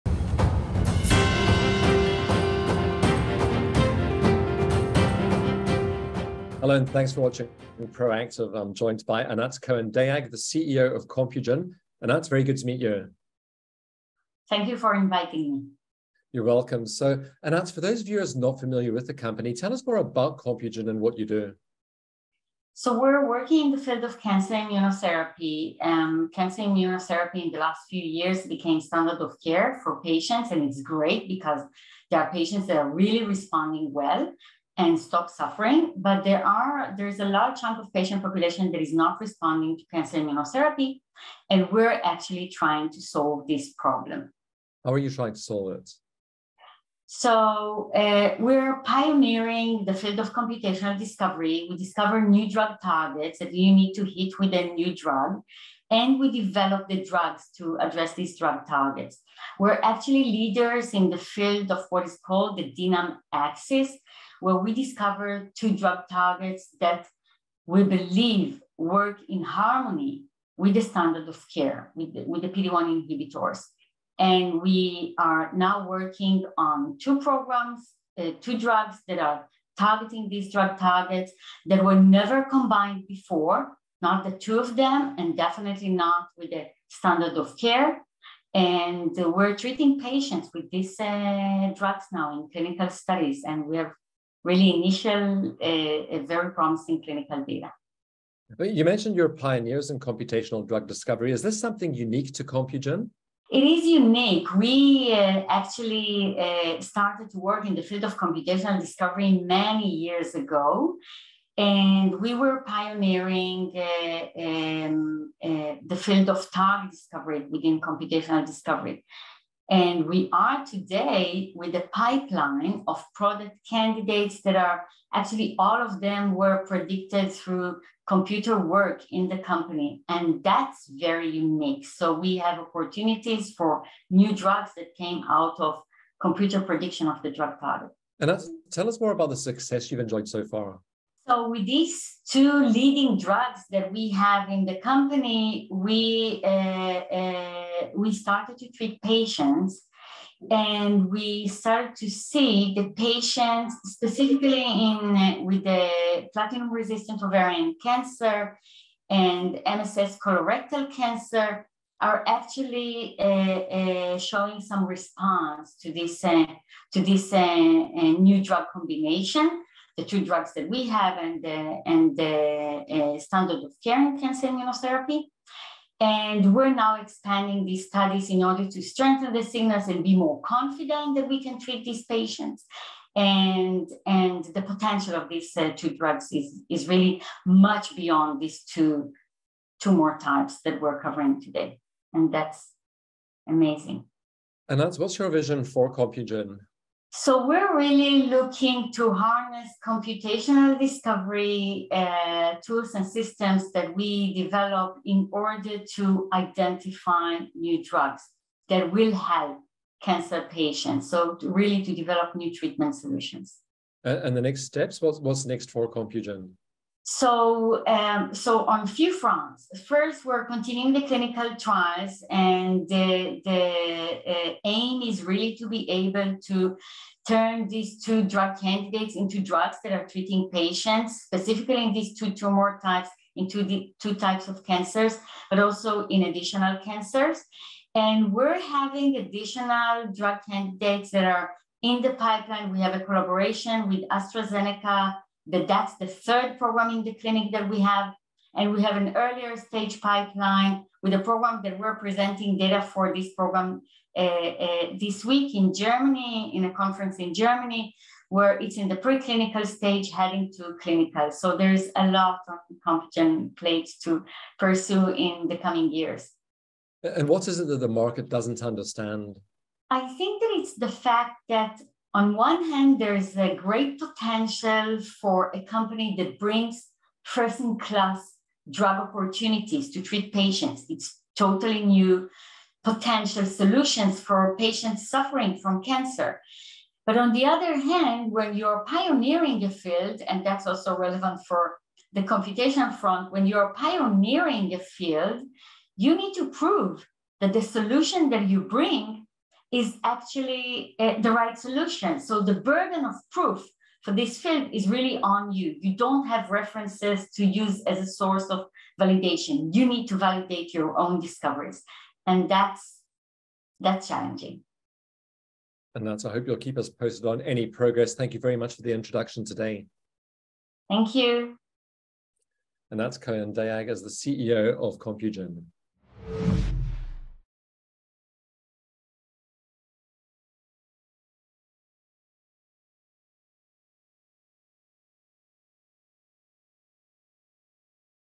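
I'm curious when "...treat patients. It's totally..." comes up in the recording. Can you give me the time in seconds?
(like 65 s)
280 s.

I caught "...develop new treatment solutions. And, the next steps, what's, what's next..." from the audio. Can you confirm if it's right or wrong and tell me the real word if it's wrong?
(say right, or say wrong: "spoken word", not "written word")
right.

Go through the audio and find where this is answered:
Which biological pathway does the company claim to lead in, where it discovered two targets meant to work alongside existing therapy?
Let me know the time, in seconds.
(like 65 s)
62 s.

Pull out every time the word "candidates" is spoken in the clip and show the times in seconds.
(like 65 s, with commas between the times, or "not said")
123 s, 228 s, 240 s.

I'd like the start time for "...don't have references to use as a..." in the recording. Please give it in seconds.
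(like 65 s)
305 s.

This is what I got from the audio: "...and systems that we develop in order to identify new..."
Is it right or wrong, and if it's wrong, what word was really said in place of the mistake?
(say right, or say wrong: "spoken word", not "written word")
right.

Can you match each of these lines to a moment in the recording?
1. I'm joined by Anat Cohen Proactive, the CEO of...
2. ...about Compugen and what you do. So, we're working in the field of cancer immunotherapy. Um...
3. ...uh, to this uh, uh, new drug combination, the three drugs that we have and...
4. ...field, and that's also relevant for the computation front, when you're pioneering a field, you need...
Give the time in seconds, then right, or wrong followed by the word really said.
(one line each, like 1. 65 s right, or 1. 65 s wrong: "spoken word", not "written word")
1. 8 s wrong: "Dayag", not "Proactive"
2. 19 s right
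3. 166 s wrong: "two", not "three"
4. 289 s right.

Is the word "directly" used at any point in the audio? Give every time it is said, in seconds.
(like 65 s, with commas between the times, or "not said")
not said.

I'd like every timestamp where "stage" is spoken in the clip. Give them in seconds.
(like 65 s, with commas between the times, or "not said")
249 s, 259 s.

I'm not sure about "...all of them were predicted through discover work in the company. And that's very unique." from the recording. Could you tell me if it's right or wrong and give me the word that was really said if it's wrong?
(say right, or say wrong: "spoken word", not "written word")
wrong: "computer", not "discover".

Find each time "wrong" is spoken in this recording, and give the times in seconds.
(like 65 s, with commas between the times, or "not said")
not said.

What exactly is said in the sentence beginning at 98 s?
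You mentioned you're pioneers in computational drug discovery.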